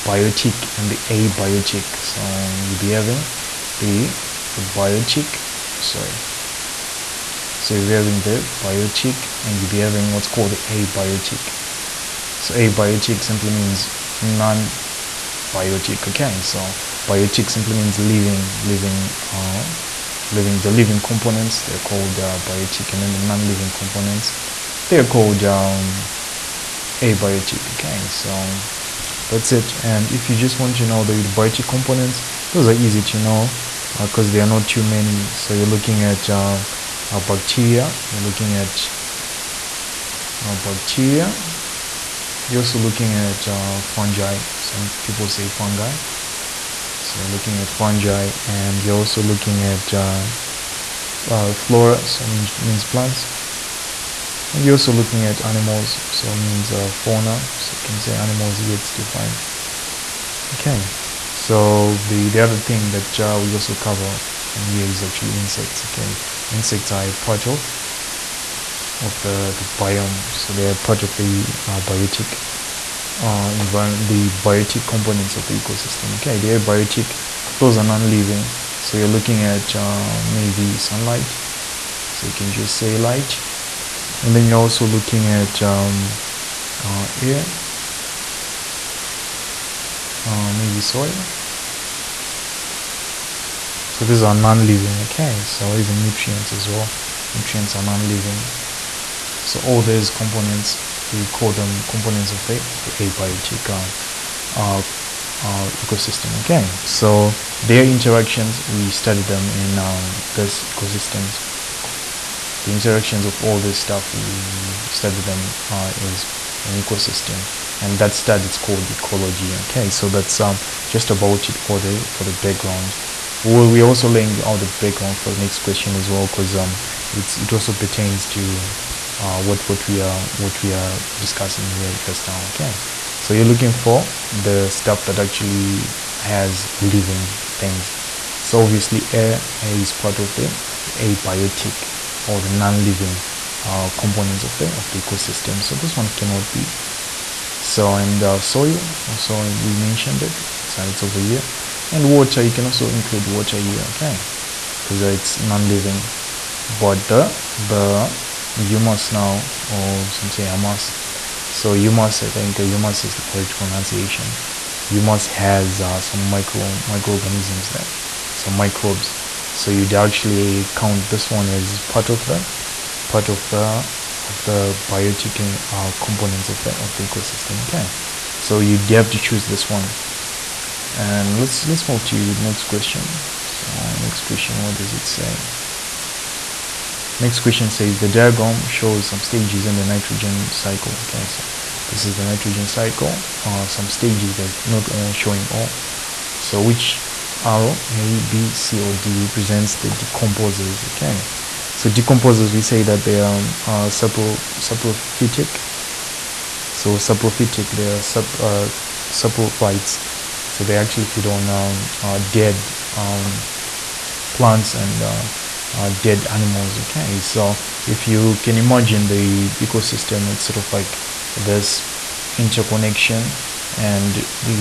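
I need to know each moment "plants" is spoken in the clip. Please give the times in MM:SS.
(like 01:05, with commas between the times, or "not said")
00:52, 03:34.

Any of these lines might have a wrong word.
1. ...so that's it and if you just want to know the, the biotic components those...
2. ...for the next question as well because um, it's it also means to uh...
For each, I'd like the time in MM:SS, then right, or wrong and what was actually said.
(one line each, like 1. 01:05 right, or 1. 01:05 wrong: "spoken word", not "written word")
1. 00:28 right
2. 02:05 wrong: "pertains", not "means".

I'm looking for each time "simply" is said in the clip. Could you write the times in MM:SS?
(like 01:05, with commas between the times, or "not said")
00:13, 00:17.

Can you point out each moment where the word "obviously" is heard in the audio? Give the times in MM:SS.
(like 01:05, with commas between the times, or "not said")
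02:18.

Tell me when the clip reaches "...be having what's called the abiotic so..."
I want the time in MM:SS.
00:09.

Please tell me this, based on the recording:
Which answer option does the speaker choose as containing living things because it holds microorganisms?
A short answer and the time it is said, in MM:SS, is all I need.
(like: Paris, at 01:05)
Humus, at 02:40.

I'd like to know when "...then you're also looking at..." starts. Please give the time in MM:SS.
01:24.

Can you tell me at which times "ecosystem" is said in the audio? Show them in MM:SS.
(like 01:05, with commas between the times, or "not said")
01:15, 01:45, 01:50, 01:56, 02:24, 02:57, 03:39.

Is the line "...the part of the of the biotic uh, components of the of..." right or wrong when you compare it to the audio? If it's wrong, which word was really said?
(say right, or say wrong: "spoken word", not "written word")
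right.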